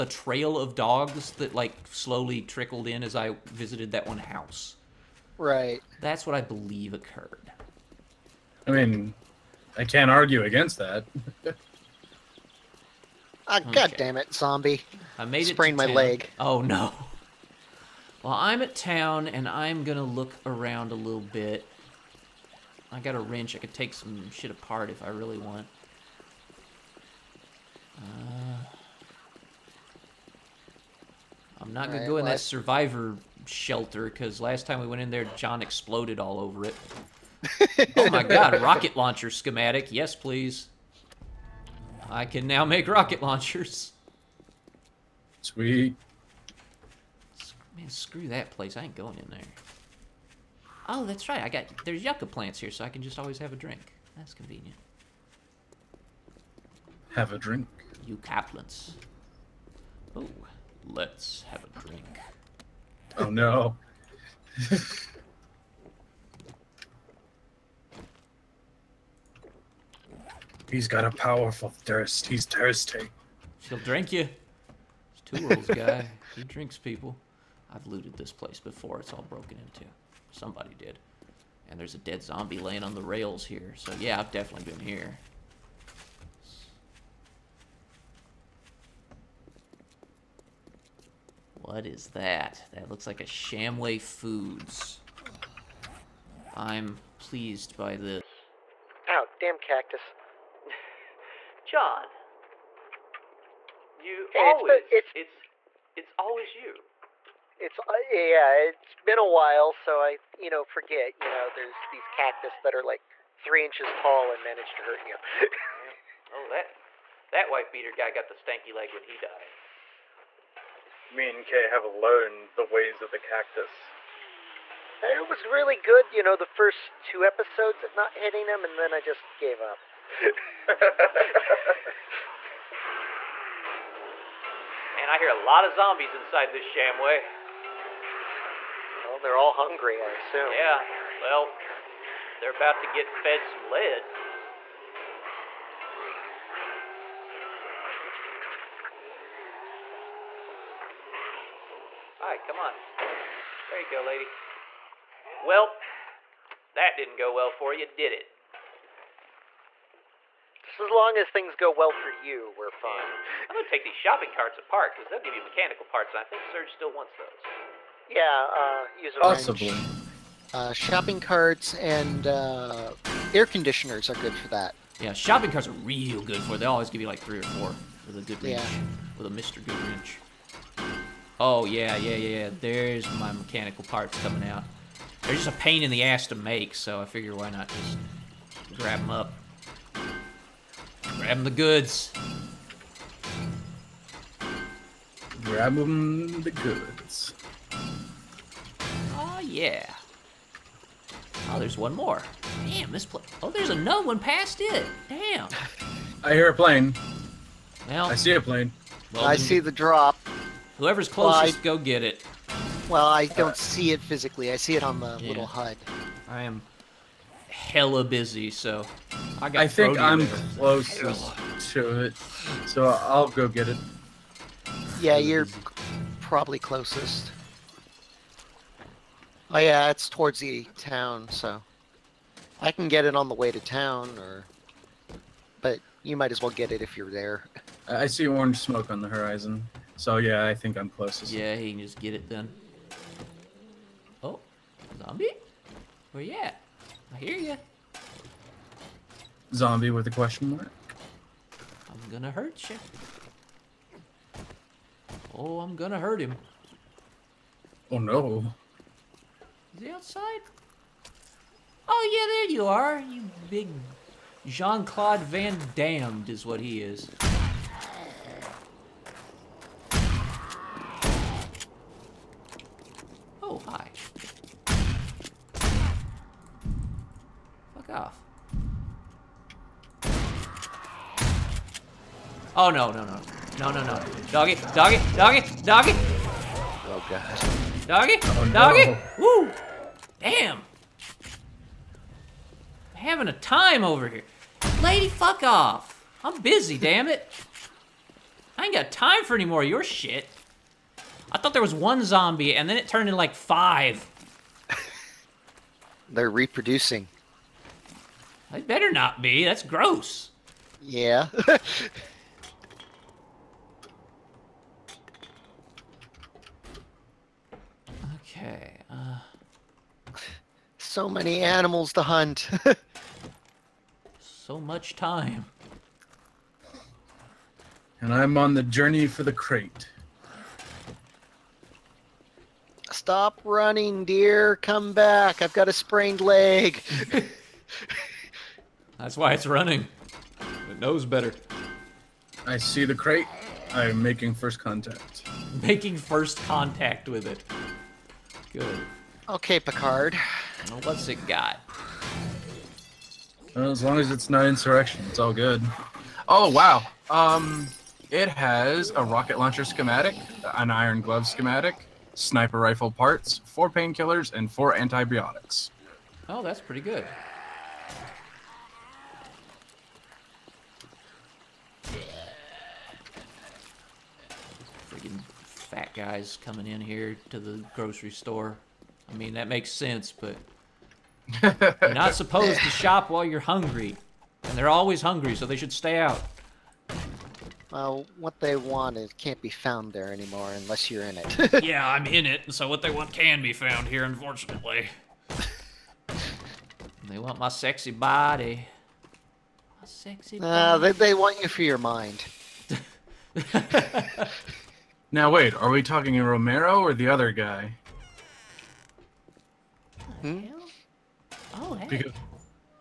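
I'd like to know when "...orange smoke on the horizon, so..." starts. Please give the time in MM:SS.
03:58.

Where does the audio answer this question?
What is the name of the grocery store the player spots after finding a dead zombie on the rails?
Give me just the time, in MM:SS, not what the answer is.
01:33.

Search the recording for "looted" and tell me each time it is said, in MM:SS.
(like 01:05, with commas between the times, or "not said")
01:17.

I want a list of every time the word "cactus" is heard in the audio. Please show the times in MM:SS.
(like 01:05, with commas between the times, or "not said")
01:39, 01:52, 02:03.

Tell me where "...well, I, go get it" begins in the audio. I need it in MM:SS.
03:31.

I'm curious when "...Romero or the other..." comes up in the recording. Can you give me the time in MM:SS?
06:46.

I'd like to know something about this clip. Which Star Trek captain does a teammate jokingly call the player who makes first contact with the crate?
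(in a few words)
Picard.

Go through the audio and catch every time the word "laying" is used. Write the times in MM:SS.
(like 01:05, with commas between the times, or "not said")
01:22.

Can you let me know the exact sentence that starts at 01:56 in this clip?
Oh, that that wife beater guy got the stanky leg when he died.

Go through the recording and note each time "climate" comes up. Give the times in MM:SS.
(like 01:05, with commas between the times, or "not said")
not said.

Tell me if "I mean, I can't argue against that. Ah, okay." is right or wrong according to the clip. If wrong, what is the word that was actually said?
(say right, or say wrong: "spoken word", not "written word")
right.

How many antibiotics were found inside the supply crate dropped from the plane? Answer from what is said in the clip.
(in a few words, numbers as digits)
4.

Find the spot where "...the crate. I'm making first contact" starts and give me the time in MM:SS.
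05:42.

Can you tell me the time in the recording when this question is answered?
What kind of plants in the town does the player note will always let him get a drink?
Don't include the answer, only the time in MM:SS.
00:52.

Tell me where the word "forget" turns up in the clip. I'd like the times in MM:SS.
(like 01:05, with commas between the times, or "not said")
01:50.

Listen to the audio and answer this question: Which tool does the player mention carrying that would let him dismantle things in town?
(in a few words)
A wrench.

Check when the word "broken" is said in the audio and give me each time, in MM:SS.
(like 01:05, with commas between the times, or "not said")
01:19.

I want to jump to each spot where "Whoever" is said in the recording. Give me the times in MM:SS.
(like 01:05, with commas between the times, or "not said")
03:30.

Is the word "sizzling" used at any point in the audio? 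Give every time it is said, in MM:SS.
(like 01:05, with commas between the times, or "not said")
not said.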